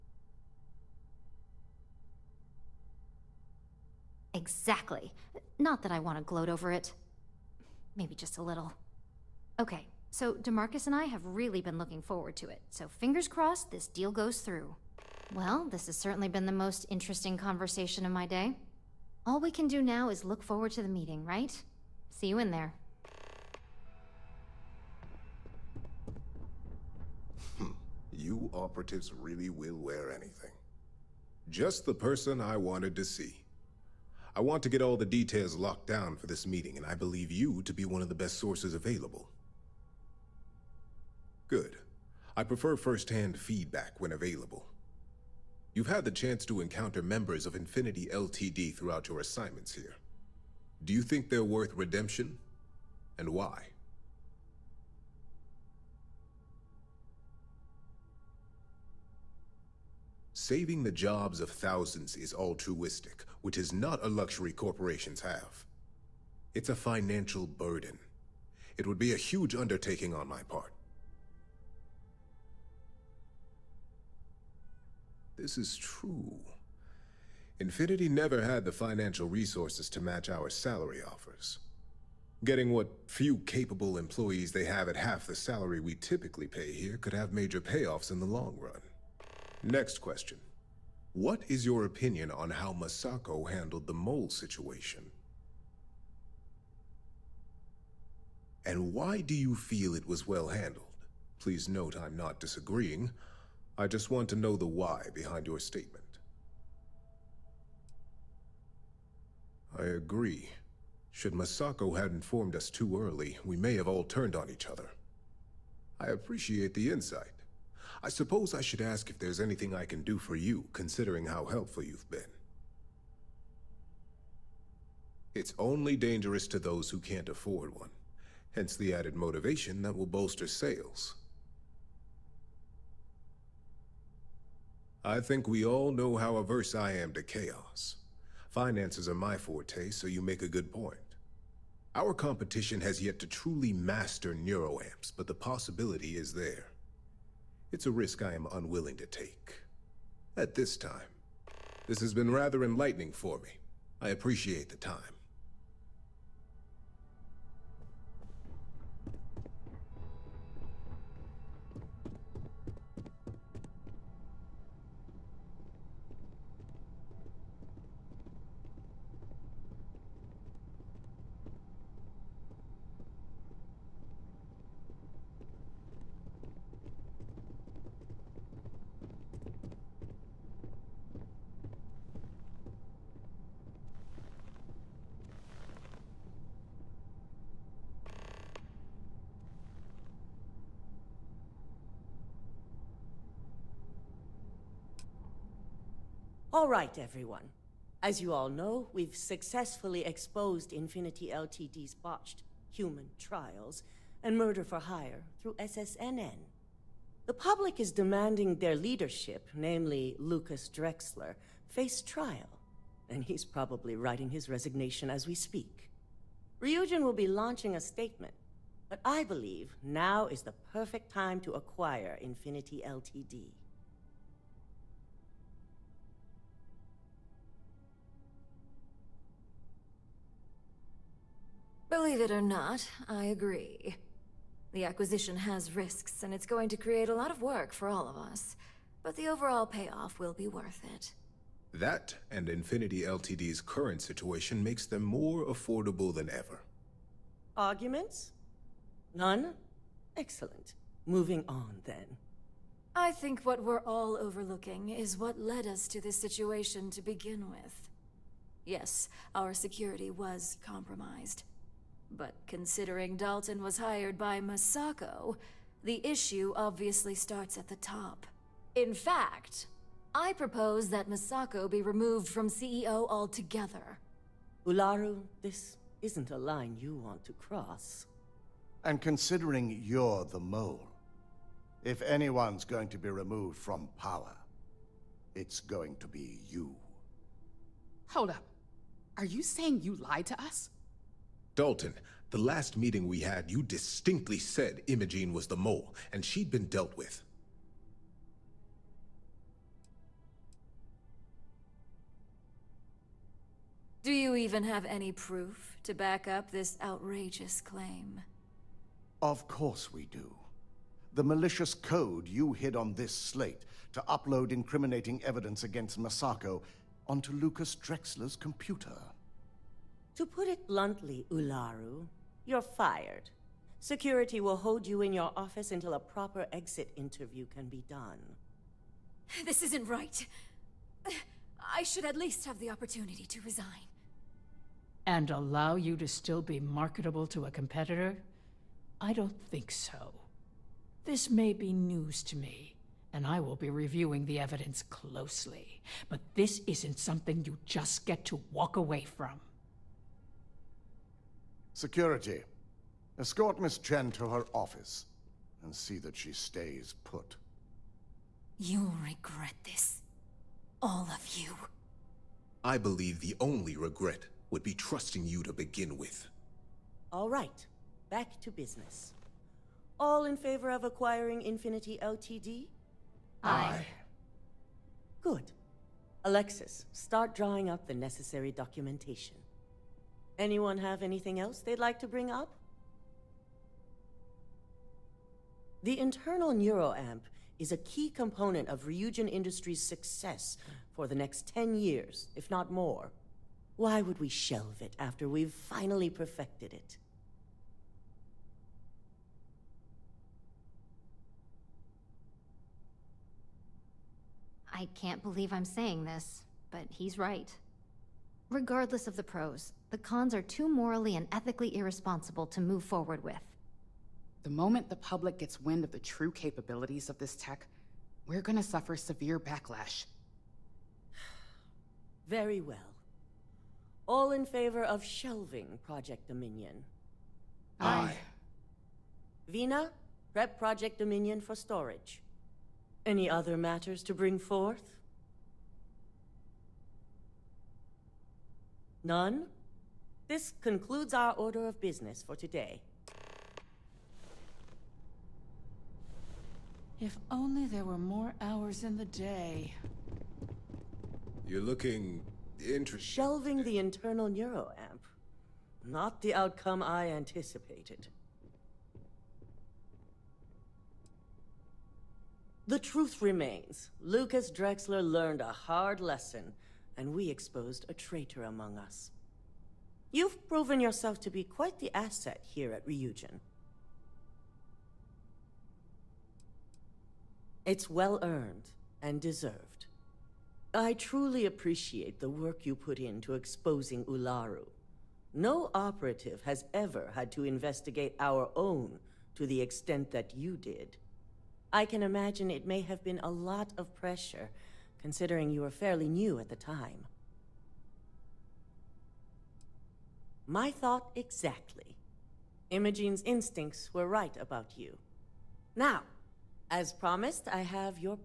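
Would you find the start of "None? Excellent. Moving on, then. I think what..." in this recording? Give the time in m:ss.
4:09.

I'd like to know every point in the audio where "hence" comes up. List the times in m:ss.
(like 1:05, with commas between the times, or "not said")
2:08.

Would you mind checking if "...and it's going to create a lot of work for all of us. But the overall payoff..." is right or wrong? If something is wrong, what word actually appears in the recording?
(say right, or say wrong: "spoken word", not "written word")
right.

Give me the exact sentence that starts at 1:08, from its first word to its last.
It would be a huge undertaking on my part.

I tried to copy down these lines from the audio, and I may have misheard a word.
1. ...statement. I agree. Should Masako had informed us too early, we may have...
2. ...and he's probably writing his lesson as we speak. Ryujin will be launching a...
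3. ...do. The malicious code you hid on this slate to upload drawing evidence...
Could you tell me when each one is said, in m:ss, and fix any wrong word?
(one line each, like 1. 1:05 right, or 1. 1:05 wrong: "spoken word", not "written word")
1. 1:45 right
2. 3:33 wrong: "resignation", not "lesson"
3. 5:10 wrong: "incriminating", not "drawing".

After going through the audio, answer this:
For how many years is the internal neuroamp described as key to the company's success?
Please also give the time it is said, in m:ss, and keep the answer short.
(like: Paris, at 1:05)
10, at 6:31.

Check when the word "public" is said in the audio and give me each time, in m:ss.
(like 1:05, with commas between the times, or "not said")
3:27, 6:54.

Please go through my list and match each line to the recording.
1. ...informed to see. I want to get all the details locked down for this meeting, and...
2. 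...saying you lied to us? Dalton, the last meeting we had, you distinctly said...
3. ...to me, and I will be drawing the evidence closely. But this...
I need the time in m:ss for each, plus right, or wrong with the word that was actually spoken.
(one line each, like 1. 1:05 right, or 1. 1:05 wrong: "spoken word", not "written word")
1. 0:32 wrong: "wanted", not "informed"
2. 4:49 right
3. 5:42 wrong: "reviewing", not "drawing".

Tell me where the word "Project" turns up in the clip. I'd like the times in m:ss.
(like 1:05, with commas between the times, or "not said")
7:05, 7:10.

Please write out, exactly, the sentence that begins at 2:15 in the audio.
I think we all know how averse I am to chaos.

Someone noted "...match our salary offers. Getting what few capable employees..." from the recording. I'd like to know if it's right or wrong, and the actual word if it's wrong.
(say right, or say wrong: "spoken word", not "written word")
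right.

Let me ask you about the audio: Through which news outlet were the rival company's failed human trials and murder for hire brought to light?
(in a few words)
SSNN.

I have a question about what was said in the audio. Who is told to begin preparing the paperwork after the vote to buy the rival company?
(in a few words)
Alexis.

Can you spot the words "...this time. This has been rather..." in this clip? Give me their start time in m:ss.
2:30.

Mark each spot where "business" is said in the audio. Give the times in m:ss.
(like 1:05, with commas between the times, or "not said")
6:08, 7:21.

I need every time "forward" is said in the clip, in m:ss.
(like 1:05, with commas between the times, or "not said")
0:12, 0:20, 6:52.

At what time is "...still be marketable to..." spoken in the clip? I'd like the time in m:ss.
5:36.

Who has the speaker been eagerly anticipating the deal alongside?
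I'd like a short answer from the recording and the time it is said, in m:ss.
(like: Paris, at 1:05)
DeMarcus, at 0:10.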